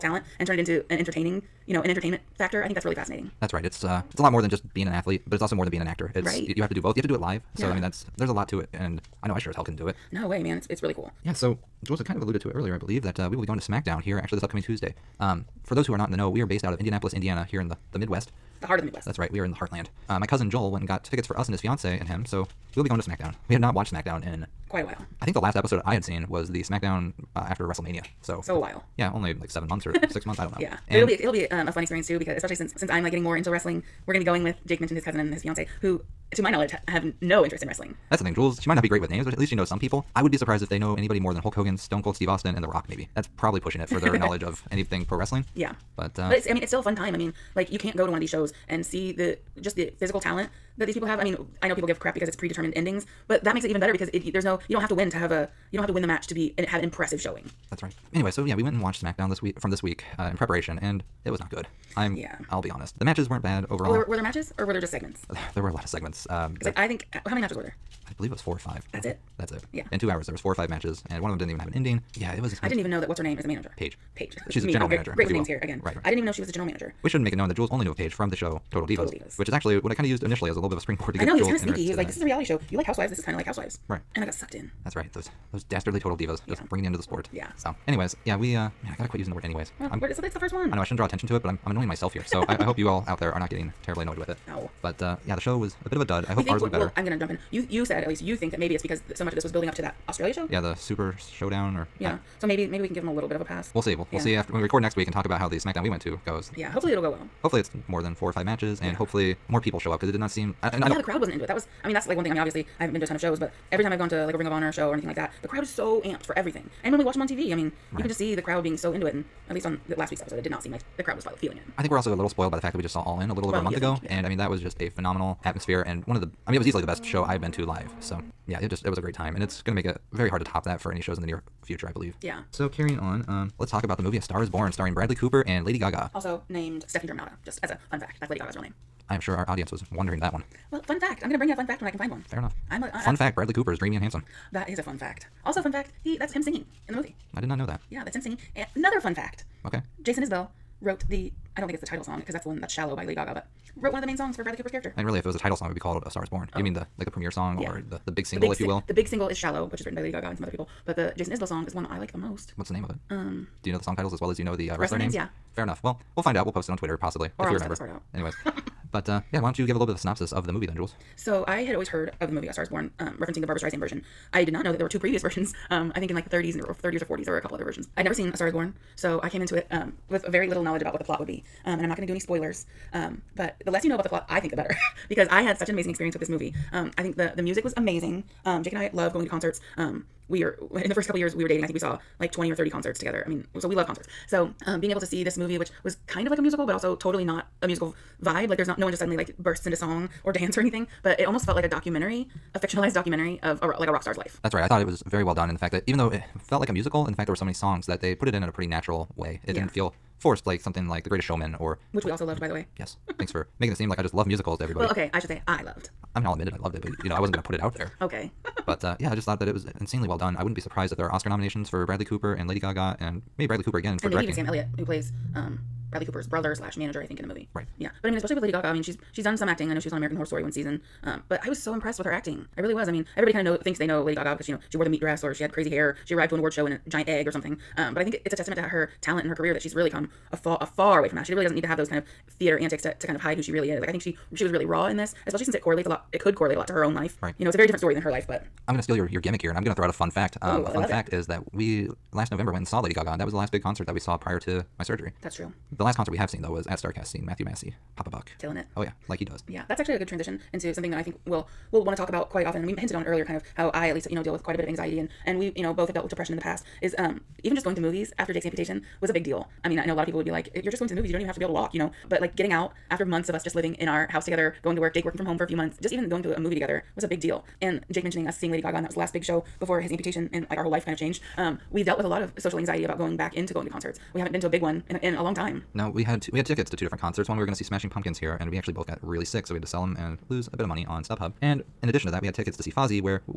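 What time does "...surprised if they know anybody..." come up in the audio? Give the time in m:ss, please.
0:40.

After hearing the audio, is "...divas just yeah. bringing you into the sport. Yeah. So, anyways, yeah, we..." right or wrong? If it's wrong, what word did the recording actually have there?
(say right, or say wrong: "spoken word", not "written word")
right.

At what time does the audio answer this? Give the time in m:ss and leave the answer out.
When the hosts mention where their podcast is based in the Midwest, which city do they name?
0:16.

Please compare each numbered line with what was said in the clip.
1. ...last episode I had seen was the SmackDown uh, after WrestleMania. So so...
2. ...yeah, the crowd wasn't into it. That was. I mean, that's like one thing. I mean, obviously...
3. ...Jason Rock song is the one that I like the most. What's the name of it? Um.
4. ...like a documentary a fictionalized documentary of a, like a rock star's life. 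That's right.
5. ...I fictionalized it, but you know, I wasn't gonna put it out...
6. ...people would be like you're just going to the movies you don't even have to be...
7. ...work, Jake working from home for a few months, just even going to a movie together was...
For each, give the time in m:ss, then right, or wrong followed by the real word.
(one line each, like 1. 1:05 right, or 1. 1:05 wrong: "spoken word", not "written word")
1. 0:25 right
2. 1:50 right
3. 2:41 wrong: "Isbell", not "Rock"
4. 3:21 right
5. 3:36 wrong: "loved", not "fictionalized"
6. 4:30 right
7. 4:34 right.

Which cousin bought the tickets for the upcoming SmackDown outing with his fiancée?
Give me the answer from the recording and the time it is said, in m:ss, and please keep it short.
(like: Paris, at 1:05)
Joel, at 0:20.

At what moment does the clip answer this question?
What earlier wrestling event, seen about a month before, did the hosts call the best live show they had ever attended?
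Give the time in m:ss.
2:03.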